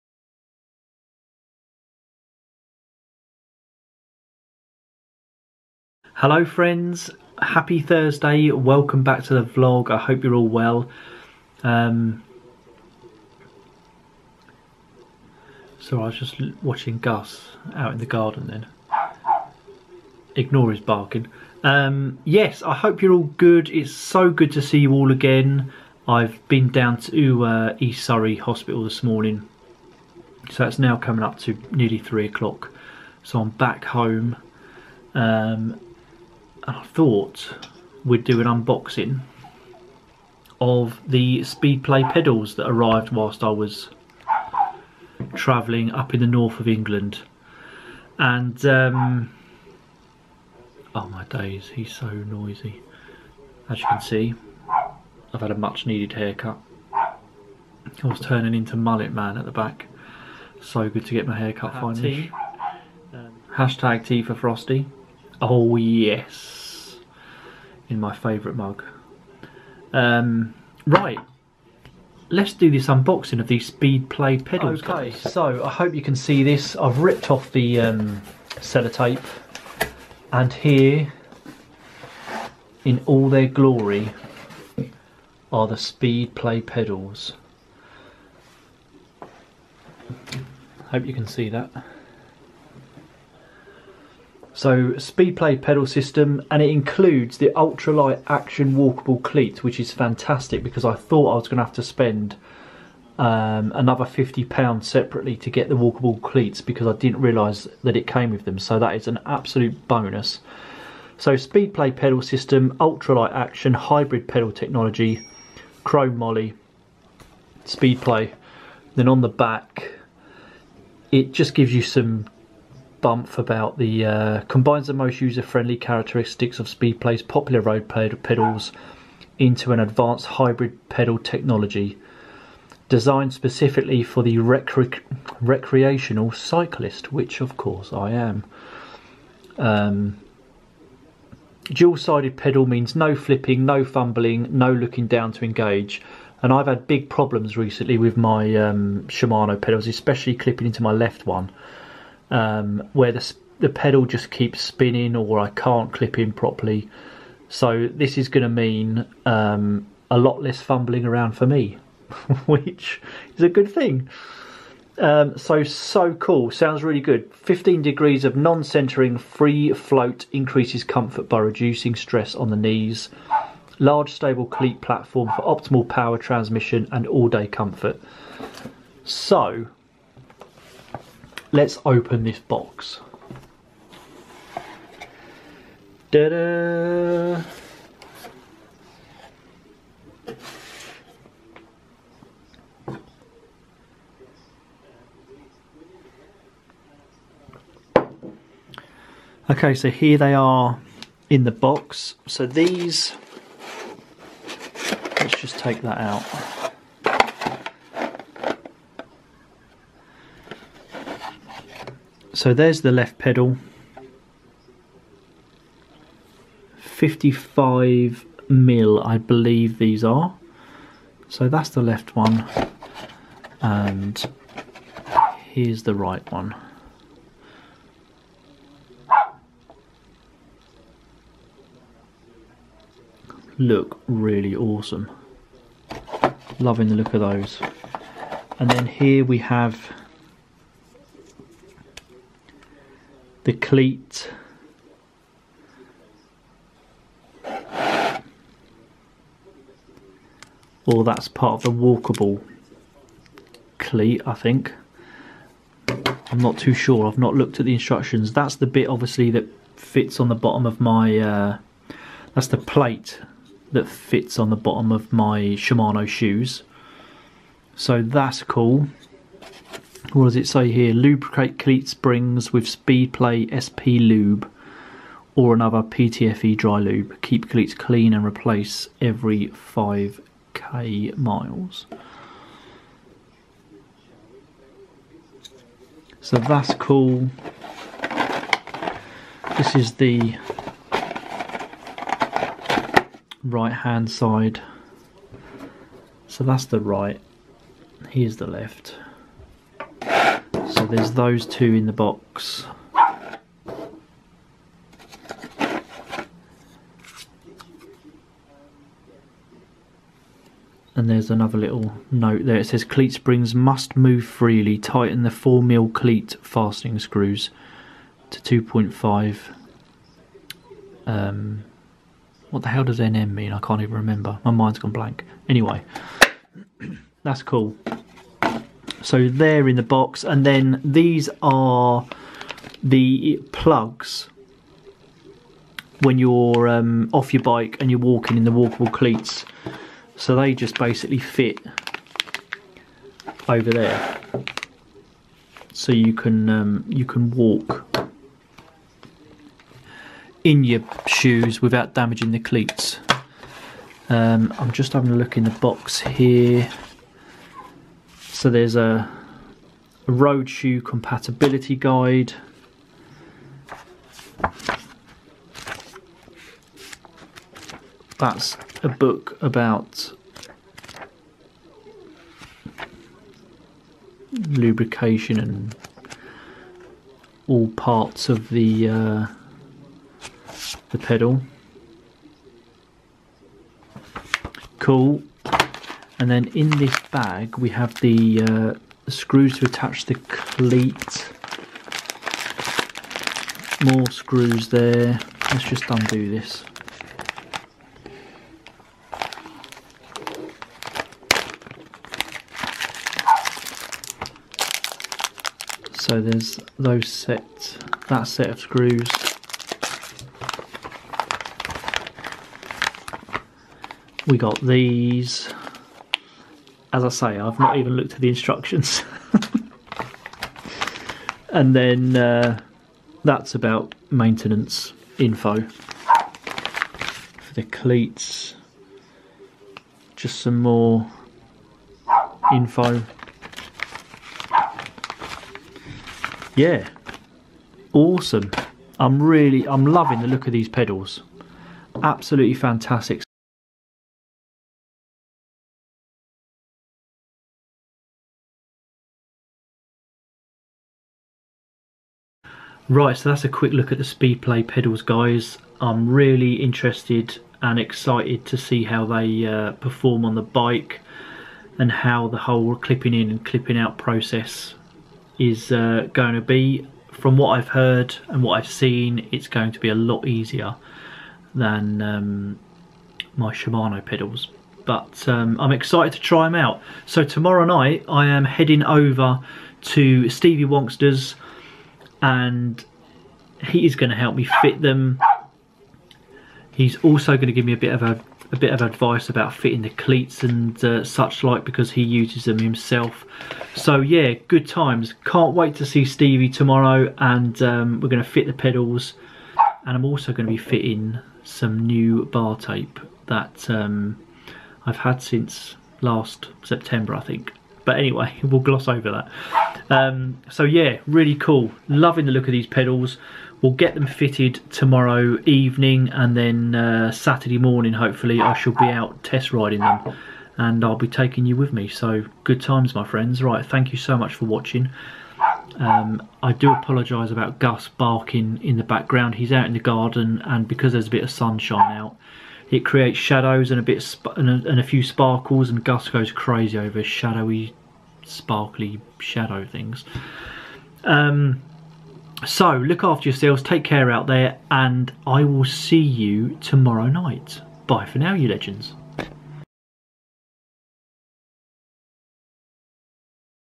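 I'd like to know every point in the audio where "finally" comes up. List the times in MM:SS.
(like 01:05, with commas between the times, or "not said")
01:01.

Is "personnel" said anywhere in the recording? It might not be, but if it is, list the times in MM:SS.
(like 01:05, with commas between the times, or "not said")
not said.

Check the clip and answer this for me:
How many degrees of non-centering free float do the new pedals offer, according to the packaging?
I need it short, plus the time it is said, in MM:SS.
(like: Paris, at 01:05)
15, at 02:47.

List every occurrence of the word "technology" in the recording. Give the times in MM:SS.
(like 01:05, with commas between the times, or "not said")
01:54, 02:11.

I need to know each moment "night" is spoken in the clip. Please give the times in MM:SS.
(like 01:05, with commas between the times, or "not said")
07:57, 09:07.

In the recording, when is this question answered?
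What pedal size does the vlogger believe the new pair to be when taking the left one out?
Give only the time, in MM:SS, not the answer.
03:36.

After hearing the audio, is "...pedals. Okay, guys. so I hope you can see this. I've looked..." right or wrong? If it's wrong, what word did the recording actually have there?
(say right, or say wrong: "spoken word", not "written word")
wrong: "ripped", not "looked".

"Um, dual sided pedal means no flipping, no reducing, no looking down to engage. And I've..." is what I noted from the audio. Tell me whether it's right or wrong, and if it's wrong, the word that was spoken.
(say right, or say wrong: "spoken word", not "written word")
wrong: "fumbling", not "reducing".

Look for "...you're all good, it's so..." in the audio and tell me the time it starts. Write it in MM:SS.
00:23.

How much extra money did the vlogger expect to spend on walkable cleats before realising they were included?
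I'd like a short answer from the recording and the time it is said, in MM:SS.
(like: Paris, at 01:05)
£50, at 01:44.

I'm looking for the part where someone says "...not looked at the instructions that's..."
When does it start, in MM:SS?
04:17.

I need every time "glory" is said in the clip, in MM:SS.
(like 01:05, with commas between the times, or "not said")
01:23.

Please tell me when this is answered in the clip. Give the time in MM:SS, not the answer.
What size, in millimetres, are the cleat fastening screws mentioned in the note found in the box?
05:15.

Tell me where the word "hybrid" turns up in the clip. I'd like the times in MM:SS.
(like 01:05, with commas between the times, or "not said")
01:53, 02:10.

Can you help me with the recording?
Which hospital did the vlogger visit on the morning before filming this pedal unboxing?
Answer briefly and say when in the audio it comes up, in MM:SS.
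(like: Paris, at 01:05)
East Surrey Hospital, at 00:27.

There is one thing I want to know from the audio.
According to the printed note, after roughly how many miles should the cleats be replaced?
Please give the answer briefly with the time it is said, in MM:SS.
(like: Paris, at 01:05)
5k miles, at 04:39.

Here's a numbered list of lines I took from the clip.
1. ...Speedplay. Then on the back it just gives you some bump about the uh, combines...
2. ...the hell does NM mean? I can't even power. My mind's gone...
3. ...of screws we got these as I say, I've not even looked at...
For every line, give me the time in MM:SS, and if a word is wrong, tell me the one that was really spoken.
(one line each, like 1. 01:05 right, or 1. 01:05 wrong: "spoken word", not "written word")
1. 01:57 right
2. 05:22 wrong: "remember", not "power"
3. 06:48 right.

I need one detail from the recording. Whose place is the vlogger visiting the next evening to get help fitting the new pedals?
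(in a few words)
Stevie Wonkster.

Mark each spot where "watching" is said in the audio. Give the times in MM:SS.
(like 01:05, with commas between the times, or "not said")
00:16, 08:44.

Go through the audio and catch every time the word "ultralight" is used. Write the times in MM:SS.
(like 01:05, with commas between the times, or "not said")
01:37, 01:52.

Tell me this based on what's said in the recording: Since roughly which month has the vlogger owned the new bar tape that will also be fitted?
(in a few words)
September.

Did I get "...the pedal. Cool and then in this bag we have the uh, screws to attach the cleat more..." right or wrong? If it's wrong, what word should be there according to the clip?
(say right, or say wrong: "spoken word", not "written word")
right.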